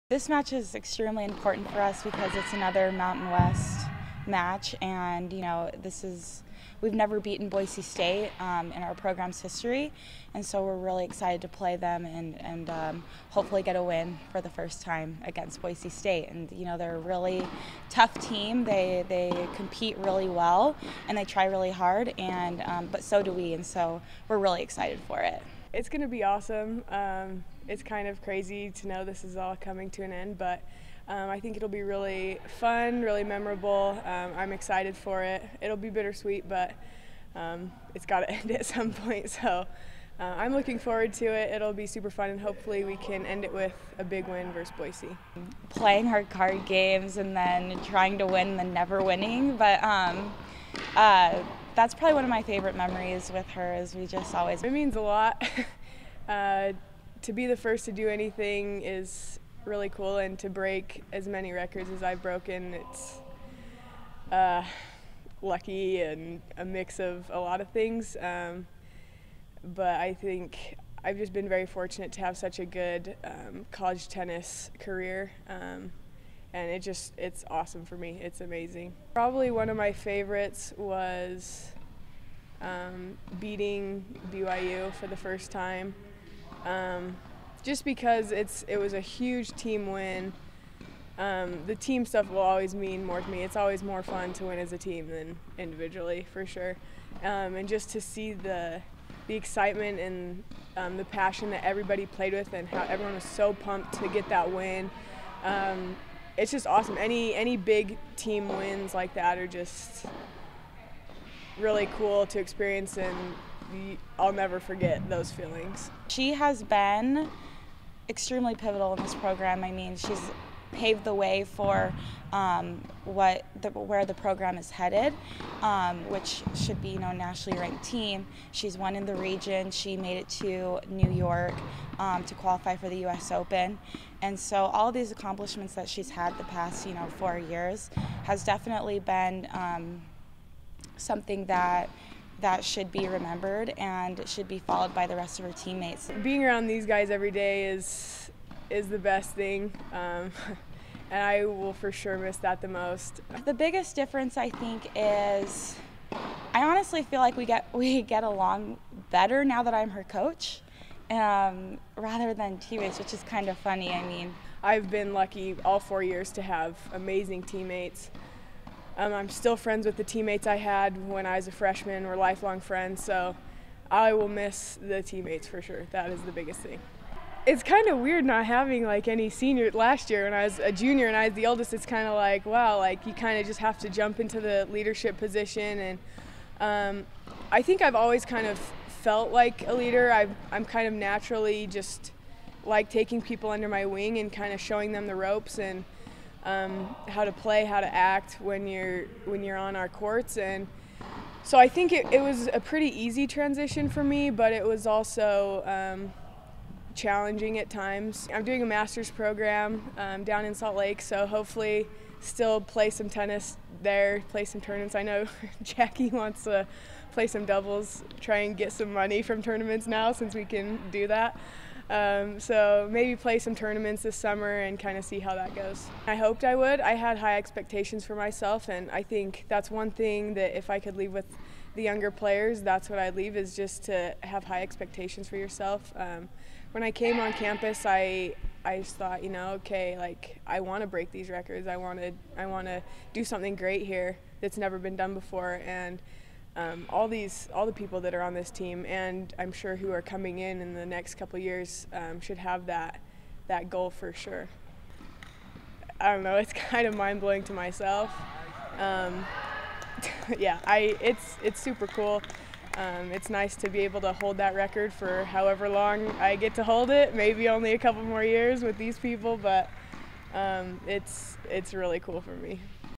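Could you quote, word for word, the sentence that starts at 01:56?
She has been extremely pivotal in this program.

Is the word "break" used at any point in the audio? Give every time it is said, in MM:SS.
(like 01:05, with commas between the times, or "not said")
01:00, 04:00.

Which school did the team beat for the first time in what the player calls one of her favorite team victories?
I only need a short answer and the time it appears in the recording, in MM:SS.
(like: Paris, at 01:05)
BYU, at 01:24.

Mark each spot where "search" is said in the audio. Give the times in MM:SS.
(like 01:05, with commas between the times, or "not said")
not said.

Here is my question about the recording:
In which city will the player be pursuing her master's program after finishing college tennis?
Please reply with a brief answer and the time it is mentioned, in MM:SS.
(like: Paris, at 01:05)
Salt Lake, at 03:30.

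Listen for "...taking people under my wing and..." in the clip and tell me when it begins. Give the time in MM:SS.
03:12.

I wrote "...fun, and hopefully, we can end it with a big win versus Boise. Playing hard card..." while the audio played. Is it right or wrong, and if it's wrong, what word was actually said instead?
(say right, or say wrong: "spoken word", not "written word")
right.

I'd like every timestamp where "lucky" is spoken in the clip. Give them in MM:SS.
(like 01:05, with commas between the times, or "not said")
01:05, 02:45.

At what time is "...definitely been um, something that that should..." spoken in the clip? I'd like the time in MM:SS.
02:18.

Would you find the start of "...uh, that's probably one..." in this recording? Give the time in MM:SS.
00:50.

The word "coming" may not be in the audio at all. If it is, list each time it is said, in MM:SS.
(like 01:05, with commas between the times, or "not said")
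00:29, 04:10.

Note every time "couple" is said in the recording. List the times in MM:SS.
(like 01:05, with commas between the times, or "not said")
04:11, 04:27.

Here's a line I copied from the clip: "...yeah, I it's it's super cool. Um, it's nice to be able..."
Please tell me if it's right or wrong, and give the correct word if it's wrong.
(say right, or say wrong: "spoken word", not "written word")
right.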